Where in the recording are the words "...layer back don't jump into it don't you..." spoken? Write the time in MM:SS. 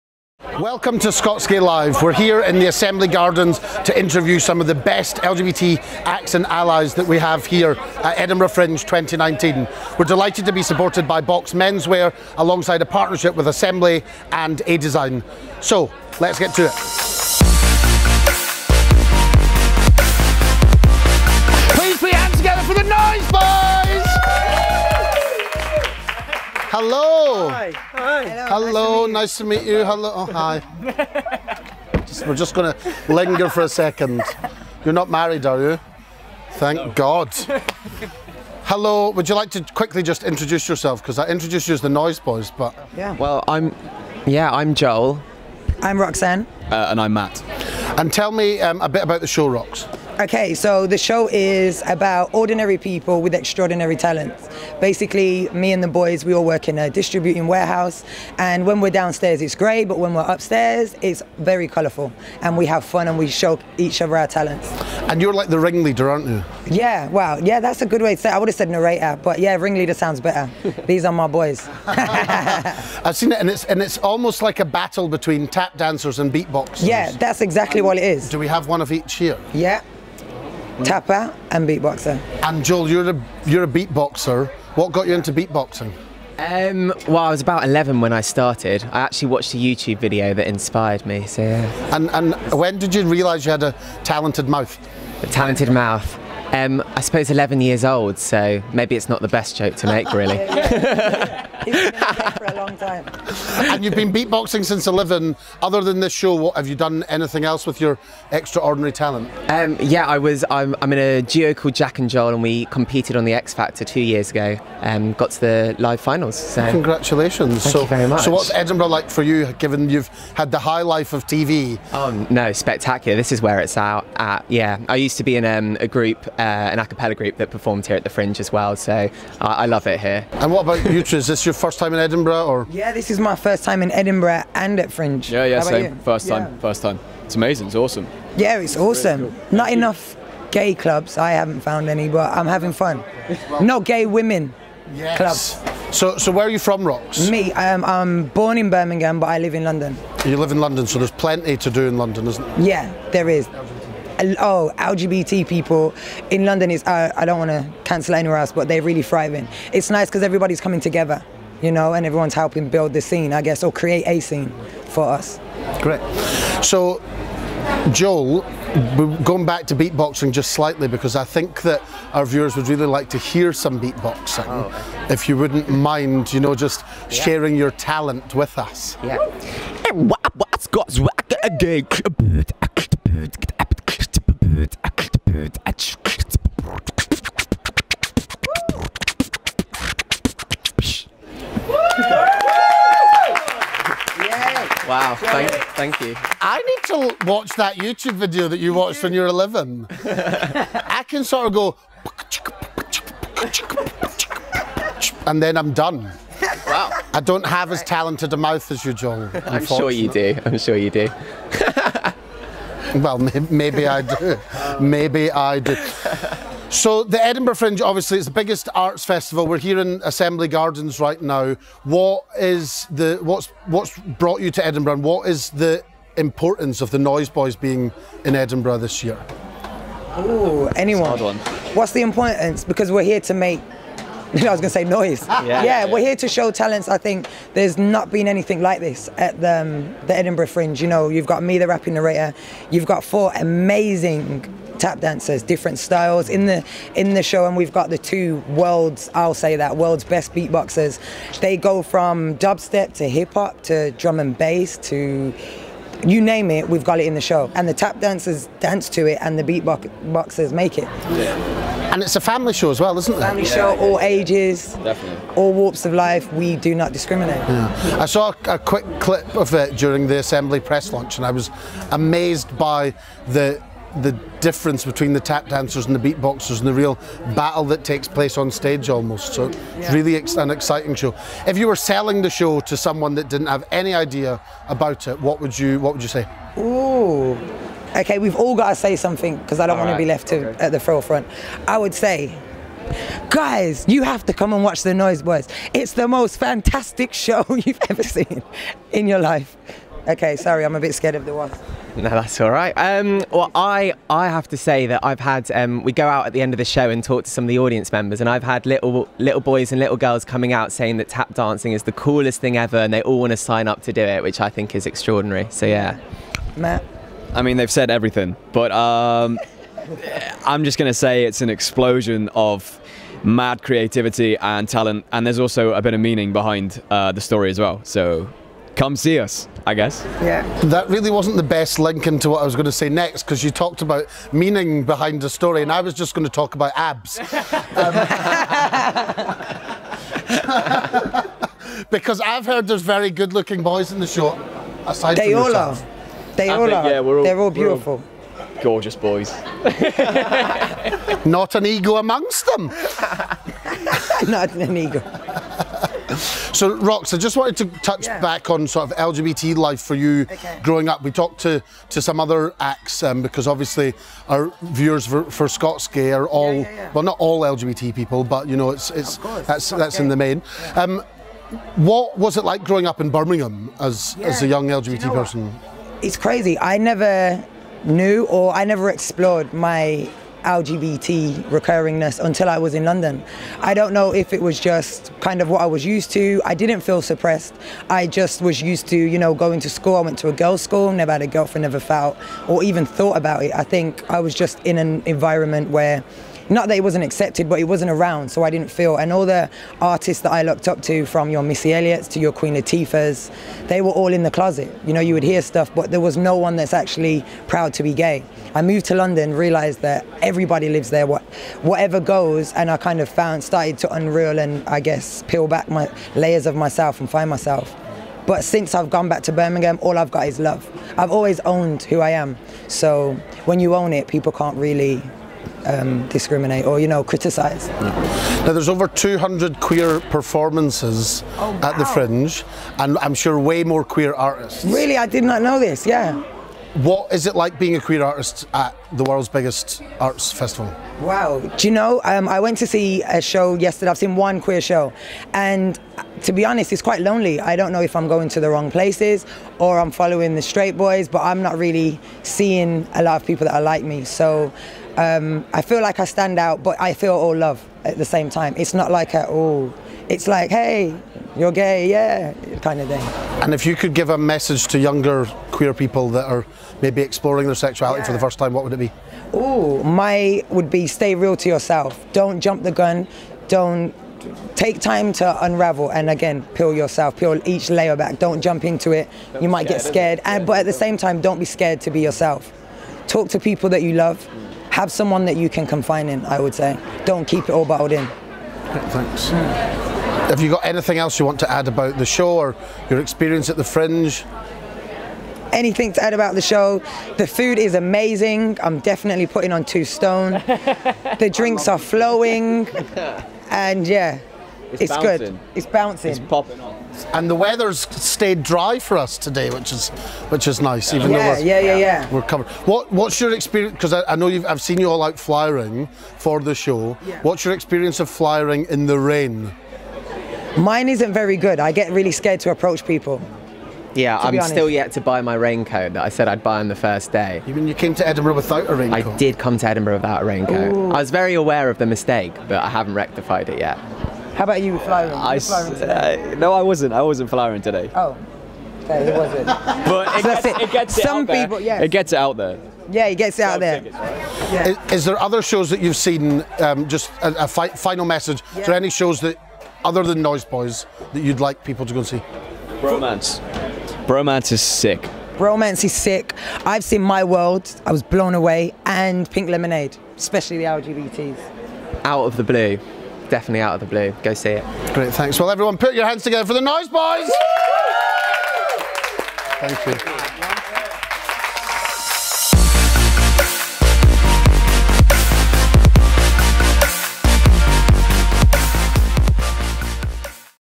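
07:57.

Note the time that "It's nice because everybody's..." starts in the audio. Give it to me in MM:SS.
02:39.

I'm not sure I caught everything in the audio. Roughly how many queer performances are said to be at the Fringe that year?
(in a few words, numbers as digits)
over 200.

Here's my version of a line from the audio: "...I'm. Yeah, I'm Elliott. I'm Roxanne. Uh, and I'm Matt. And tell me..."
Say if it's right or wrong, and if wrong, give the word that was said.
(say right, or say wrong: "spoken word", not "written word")
wrong: "Joel", not "Elliott".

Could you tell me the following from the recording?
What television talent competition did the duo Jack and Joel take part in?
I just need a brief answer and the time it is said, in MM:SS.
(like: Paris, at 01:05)
The X Factor, at 01:53.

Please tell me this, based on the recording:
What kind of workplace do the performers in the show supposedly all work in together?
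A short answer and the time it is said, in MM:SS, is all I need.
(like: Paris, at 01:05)
distributing warehouse, at 00:56.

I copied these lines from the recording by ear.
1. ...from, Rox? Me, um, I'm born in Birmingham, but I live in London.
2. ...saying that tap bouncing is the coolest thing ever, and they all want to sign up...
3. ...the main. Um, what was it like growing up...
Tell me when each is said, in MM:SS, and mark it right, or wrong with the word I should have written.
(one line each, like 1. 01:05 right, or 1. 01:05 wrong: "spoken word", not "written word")
1. 02:26 right
2. 05:10 wrong: "dancing", not "bouncing"
3. 06:10 right.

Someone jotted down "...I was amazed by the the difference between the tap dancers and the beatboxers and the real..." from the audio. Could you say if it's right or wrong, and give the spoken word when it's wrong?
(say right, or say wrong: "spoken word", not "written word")
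right.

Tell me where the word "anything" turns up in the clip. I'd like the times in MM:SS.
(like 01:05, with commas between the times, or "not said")
01:47, 03:58, 08:10, 08:15.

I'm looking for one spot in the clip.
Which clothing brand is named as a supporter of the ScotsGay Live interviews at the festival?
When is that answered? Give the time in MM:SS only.
00:11.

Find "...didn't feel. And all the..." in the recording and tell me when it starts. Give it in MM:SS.
06:38.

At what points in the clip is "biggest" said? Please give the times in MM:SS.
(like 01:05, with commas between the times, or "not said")
03:38, 07:19.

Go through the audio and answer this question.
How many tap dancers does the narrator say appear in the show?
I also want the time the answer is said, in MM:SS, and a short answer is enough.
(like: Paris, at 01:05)
4, at 04:03.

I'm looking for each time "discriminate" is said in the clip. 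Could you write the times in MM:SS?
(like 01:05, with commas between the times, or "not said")
04:26, 07:06.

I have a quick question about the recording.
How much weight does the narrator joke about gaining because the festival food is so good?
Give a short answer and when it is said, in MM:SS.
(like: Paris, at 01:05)
two stone, at 08:19.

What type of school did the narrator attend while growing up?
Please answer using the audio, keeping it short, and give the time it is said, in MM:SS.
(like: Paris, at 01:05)
girls' school, at 06:30.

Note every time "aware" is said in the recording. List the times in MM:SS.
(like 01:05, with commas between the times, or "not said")
08:51.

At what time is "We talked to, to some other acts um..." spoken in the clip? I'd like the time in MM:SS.
06:01.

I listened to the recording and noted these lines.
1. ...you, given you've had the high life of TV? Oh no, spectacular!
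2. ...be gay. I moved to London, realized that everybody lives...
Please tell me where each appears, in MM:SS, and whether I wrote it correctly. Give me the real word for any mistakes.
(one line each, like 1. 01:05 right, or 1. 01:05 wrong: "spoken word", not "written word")
1. 01:59 right
2. 06:47 right.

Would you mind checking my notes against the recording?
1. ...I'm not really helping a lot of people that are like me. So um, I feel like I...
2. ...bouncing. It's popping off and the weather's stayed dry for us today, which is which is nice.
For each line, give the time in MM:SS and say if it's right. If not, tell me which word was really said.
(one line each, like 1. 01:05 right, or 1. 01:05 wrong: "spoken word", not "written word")
1. 07:31 wrong: "seeing", not "helping"
2. 08:25 right.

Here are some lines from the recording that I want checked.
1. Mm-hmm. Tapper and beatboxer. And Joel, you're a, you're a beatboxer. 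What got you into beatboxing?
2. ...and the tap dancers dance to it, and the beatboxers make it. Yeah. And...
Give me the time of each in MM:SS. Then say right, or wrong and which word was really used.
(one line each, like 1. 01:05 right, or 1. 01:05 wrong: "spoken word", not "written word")
1. 01:20 right
2. 04:17 right.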